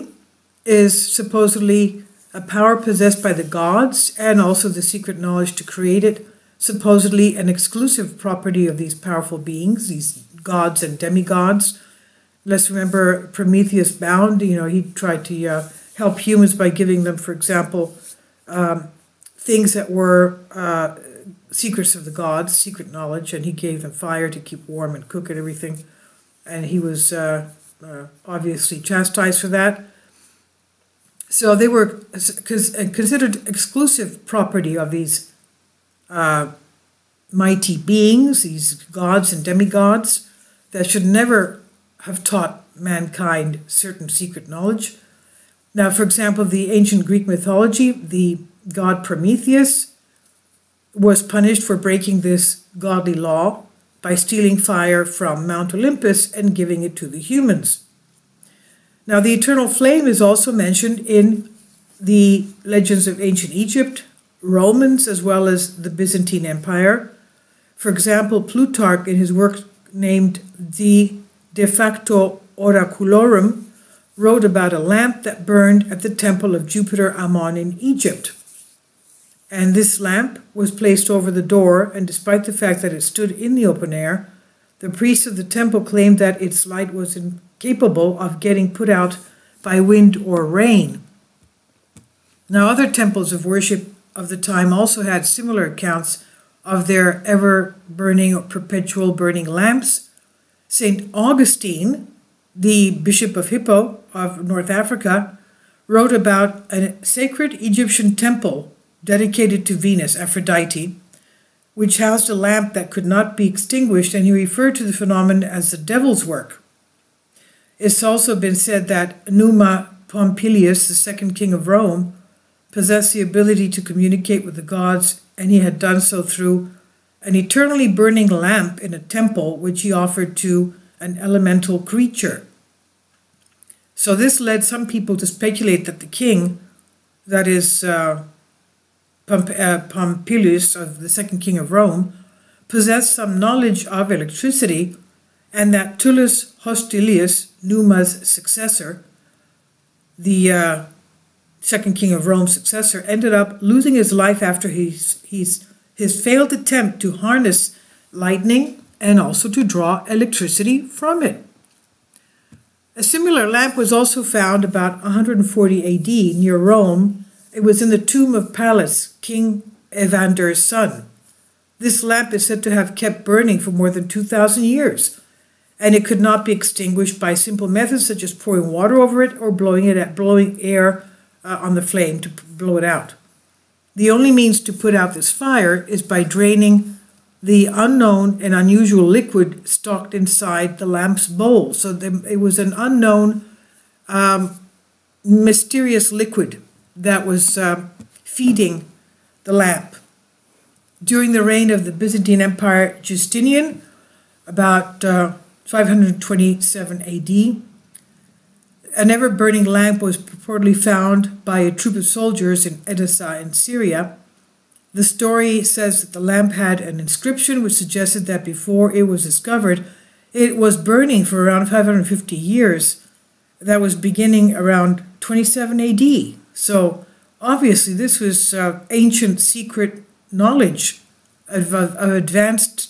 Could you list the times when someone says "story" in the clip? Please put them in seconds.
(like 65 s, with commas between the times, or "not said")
215 s.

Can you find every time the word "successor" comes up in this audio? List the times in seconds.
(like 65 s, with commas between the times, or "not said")
148 s, 152 s.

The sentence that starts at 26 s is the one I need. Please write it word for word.
And he was uh, uh obviously chastised for that.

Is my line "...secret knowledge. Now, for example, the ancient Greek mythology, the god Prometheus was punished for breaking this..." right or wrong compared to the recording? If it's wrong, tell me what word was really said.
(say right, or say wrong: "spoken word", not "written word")
right.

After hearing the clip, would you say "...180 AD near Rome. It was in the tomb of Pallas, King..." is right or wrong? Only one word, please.
wrong.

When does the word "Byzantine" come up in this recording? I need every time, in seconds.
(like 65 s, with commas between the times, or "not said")
65 s, 201 s.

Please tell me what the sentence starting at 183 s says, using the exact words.
The only means to put out this fire is by draining the unknown and unusual liquid stocked inside the lamp's bowl.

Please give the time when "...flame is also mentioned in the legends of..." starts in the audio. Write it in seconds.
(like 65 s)
59 s.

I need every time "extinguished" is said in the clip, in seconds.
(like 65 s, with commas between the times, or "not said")
113 s, 176 s.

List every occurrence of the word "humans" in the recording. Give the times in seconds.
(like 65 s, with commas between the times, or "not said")
16 s, 57 s.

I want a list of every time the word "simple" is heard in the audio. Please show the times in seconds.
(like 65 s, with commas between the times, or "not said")
177 s.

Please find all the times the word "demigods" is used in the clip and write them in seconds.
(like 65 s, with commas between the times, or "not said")
10 s, 39 s.